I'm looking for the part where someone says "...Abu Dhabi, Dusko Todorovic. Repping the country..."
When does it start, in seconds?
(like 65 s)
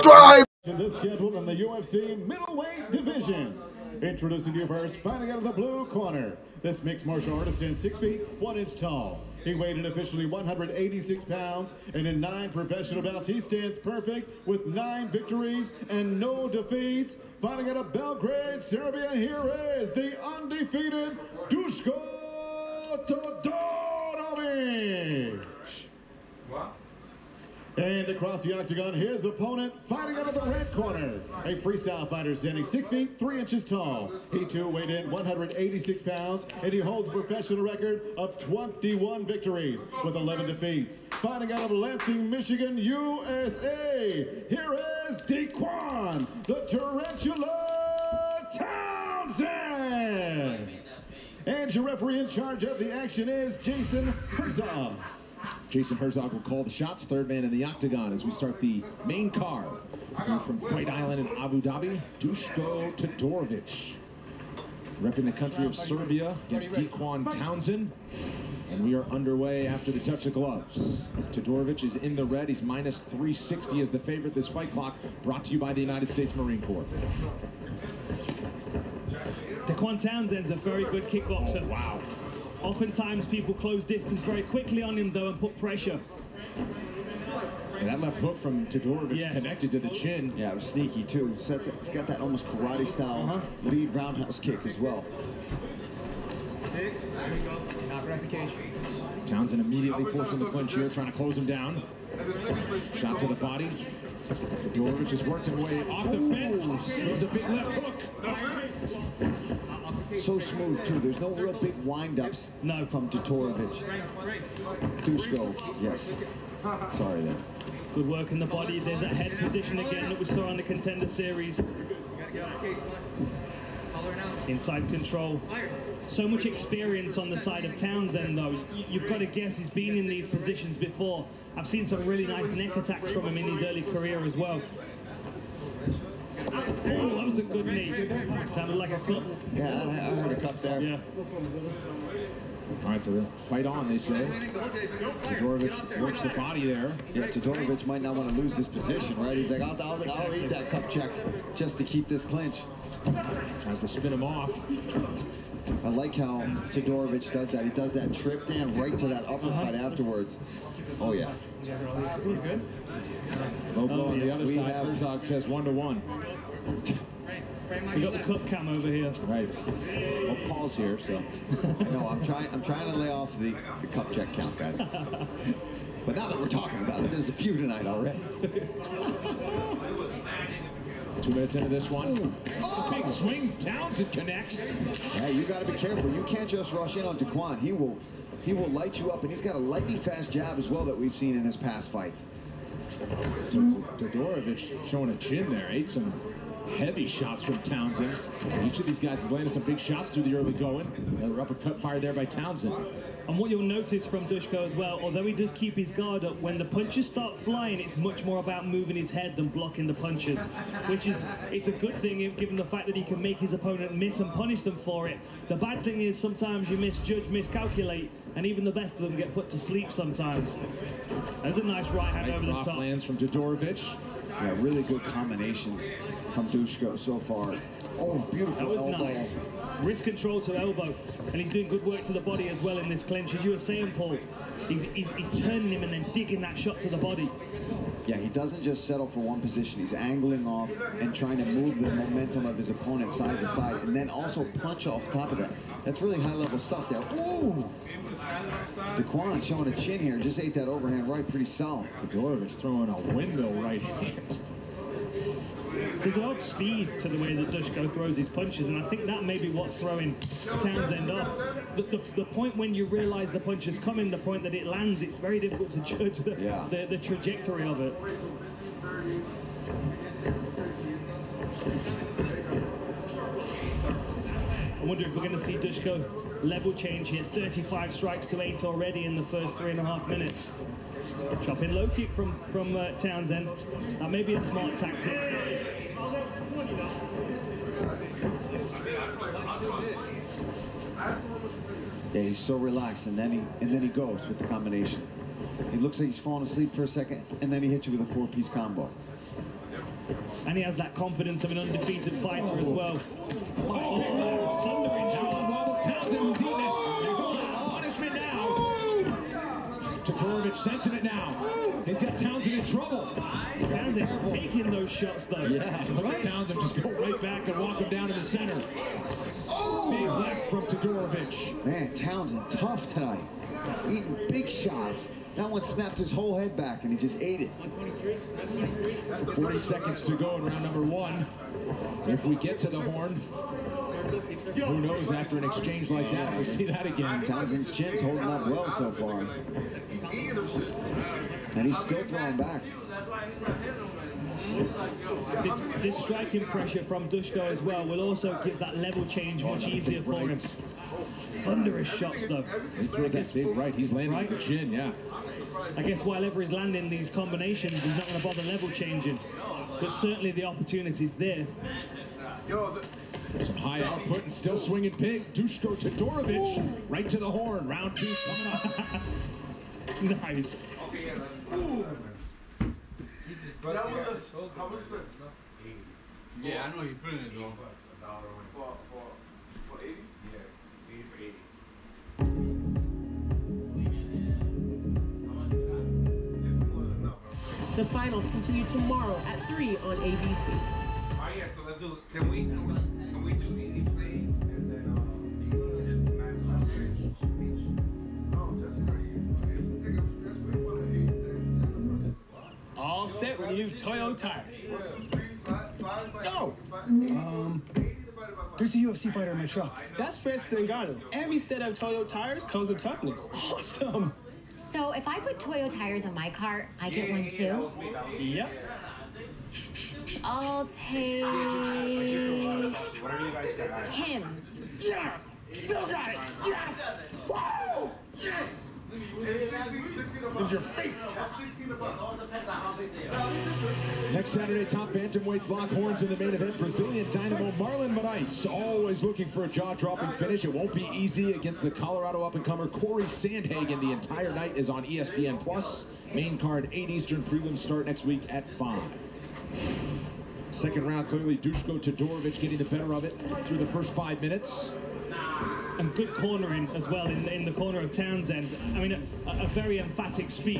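61 s.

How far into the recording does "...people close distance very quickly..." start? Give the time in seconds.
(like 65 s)
83 s.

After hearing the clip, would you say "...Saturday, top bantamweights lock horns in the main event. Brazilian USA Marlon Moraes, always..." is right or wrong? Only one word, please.
wrong.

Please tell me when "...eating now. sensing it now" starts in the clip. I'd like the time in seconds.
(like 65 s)
310 s.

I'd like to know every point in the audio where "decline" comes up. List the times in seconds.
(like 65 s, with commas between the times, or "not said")
not said.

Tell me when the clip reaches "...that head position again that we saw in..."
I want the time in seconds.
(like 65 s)
119 s.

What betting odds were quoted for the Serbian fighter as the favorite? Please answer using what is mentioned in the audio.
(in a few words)
-360.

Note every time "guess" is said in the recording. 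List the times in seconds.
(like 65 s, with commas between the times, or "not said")
129 s, 355 s.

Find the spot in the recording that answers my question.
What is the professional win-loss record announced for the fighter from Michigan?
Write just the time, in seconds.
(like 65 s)
38 s.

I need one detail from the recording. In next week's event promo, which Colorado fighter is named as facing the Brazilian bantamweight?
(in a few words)
Corey Sandhagen.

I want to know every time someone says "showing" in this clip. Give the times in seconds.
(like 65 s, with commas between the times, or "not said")
194 s, 249 s.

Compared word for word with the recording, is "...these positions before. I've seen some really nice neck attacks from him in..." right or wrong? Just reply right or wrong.
right.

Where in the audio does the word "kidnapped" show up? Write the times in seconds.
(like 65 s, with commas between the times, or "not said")
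not said.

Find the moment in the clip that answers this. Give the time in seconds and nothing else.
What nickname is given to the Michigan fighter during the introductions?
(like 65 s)
46 s.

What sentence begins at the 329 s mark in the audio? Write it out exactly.
40 seconds to go in round number one.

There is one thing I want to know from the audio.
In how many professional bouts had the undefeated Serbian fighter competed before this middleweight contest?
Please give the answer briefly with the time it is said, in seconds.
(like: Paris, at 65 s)
9, at 12 s.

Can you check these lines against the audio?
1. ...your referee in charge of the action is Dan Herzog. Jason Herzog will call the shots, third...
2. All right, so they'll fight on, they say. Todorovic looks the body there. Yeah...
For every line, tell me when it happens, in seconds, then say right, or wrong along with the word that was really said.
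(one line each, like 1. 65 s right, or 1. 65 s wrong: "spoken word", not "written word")
1. 51 s wrong: "Jason", not "Dan"
2. 142 s wrong: "works", not "looks".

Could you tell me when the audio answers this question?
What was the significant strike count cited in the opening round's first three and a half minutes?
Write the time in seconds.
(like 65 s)
277 s.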